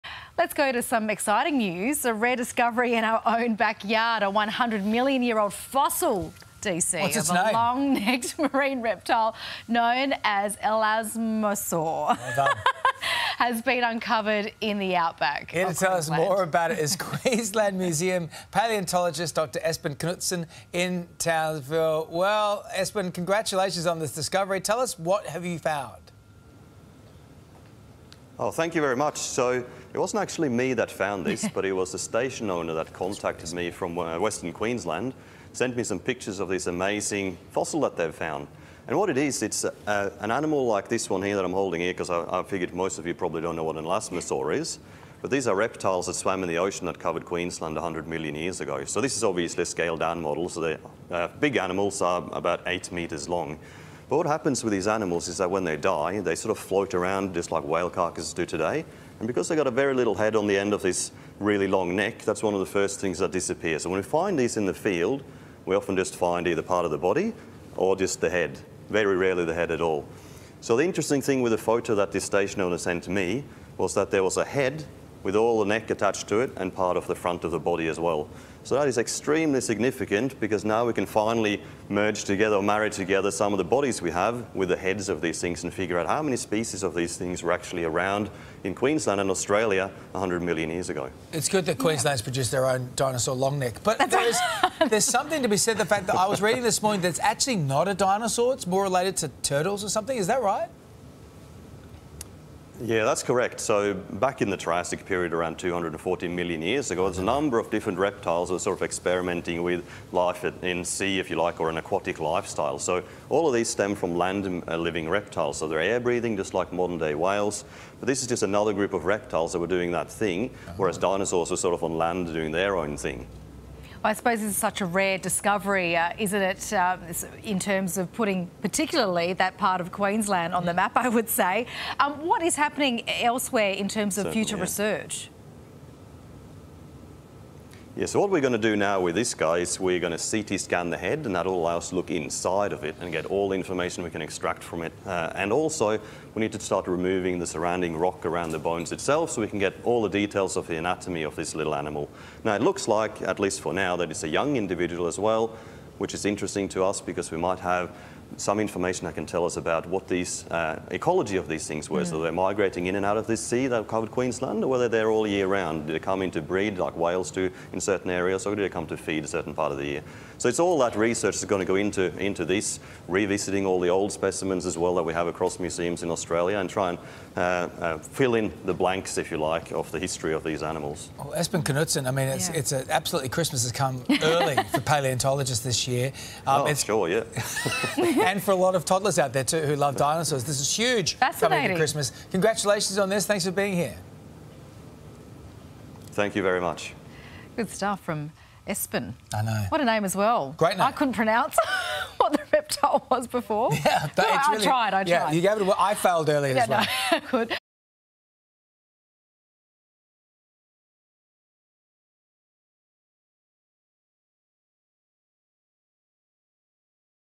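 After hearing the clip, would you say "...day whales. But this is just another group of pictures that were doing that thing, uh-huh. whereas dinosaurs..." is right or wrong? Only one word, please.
wrong.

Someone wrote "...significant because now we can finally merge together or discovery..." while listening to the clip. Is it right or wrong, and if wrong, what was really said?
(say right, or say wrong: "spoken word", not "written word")
wrong: "marry", not "discovery".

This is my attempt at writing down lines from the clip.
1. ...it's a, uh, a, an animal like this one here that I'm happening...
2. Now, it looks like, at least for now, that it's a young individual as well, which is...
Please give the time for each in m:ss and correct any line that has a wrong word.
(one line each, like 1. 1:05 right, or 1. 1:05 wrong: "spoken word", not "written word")
1. 0:39 wrong: "holding", not "happening"
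2. 2:32 right.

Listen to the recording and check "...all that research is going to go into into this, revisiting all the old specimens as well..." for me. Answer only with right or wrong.
right.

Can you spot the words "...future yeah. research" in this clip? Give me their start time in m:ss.
2:14.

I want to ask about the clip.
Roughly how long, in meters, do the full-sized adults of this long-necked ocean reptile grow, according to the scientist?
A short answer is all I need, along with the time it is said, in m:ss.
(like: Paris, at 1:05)
8 meters, at 0:52.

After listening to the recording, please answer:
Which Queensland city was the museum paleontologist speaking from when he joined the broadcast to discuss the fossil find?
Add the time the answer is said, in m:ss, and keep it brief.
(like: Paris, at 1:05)
Townsville, at 0:21.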